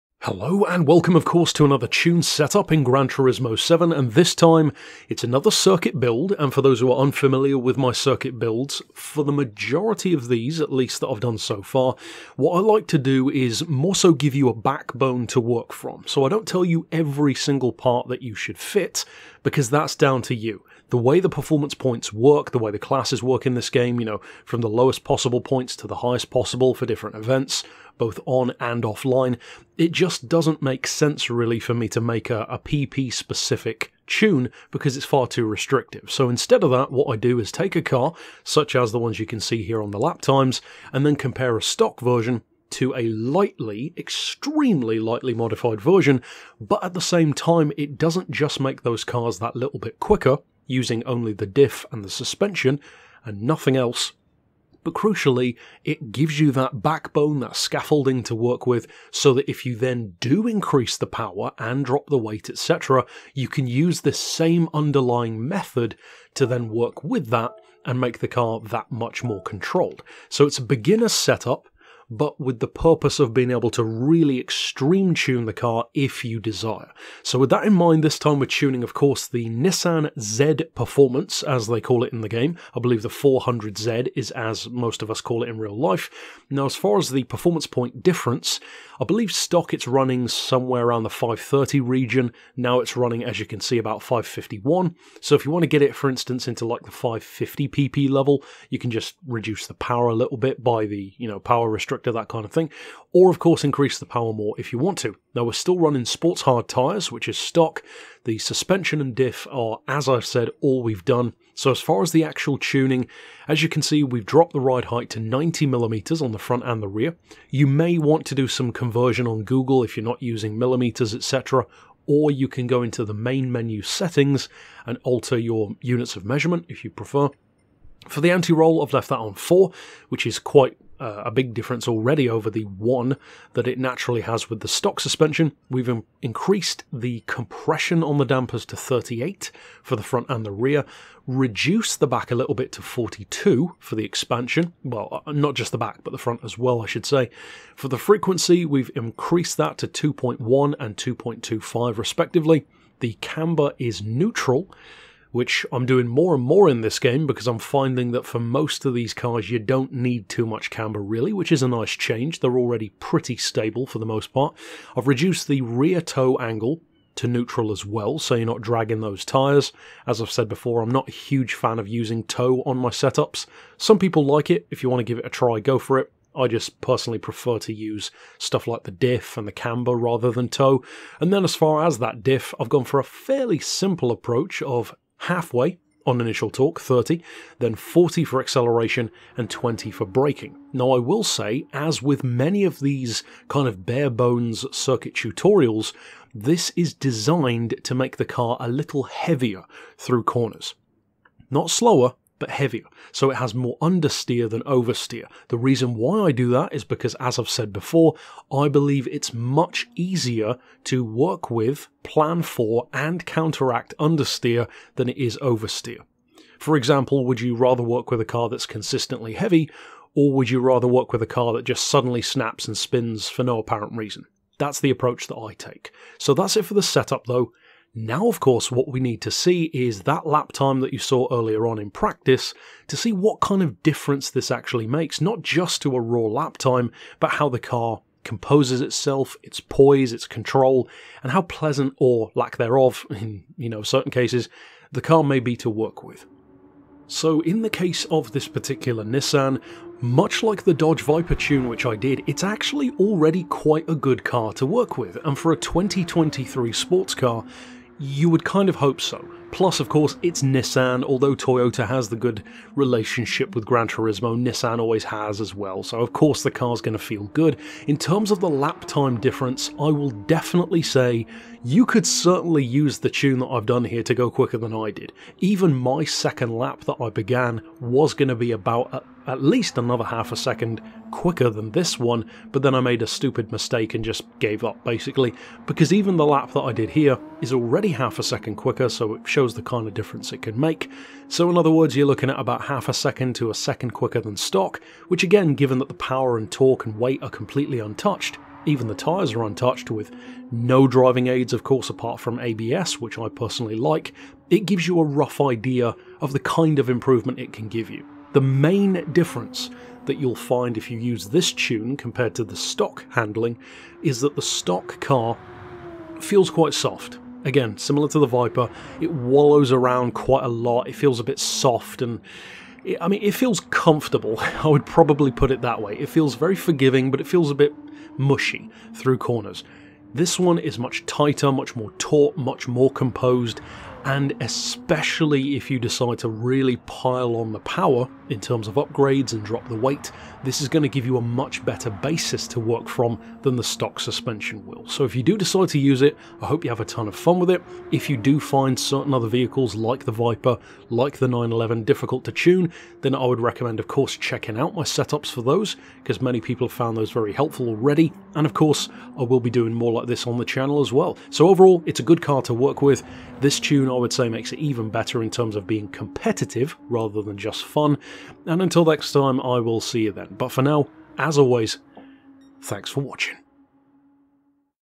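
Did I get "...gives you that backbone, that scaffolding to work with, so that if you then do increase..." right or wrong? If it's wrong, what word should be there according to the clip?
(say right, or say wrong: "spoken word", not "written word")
right.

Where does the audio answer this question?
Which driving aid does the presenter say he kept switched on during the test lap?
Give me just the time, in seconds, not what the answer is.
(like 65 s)
302 s.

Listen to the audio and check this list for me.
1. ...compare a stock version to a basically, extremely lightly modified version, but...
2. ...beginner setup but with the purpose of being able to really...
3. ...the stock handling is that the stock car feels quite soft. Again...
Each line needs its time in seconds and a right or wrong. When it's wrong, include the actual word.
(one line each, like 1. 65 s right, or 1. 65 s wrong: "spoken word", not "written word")
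1. 41 s wrong: "lightly", not "basically"
2. 70 s right
3. 312 s right.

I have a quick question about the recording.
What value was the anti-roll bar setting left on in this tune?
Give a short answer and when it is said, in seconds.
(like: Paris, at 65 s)
4, at 129 s.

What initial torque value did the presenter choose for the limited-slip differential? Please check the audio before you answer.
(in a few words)
30.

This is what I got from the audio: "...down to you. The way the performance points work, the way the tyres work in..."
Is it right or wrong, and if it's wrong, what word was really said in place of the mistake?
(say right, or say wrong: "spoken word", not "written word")
wrong: "classes", not "tyres".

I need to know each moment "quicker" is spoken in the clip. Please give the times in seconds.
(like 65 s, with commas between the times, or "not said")
49 s, 274 s, 281 s, 288 s, 293 s.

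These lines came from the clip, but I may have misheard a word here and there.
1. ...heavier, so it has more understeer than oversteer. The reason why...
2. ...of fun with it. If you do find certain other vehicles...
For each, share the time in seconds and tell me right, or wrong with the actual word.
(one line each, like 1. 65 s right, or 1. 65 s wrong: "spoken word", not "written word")
1. 202 s right
2. 347 s right.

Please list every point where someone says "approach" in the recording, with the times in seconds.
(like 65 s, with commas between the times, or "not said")
184 s, 224 s.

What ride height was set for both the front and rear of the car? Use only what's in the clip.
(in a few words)
90mm.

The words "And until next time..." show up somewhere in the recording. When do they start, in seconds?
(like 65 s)
368 s.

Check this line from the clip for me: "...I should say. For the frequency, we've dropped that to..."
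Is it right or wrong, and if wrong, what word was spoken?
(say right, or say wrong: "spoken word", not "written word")
wrong: "increased", not "dropped".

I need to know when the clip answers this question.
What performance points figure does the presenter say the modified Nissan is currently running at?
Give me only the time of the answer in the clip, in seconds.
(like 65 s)
94 s.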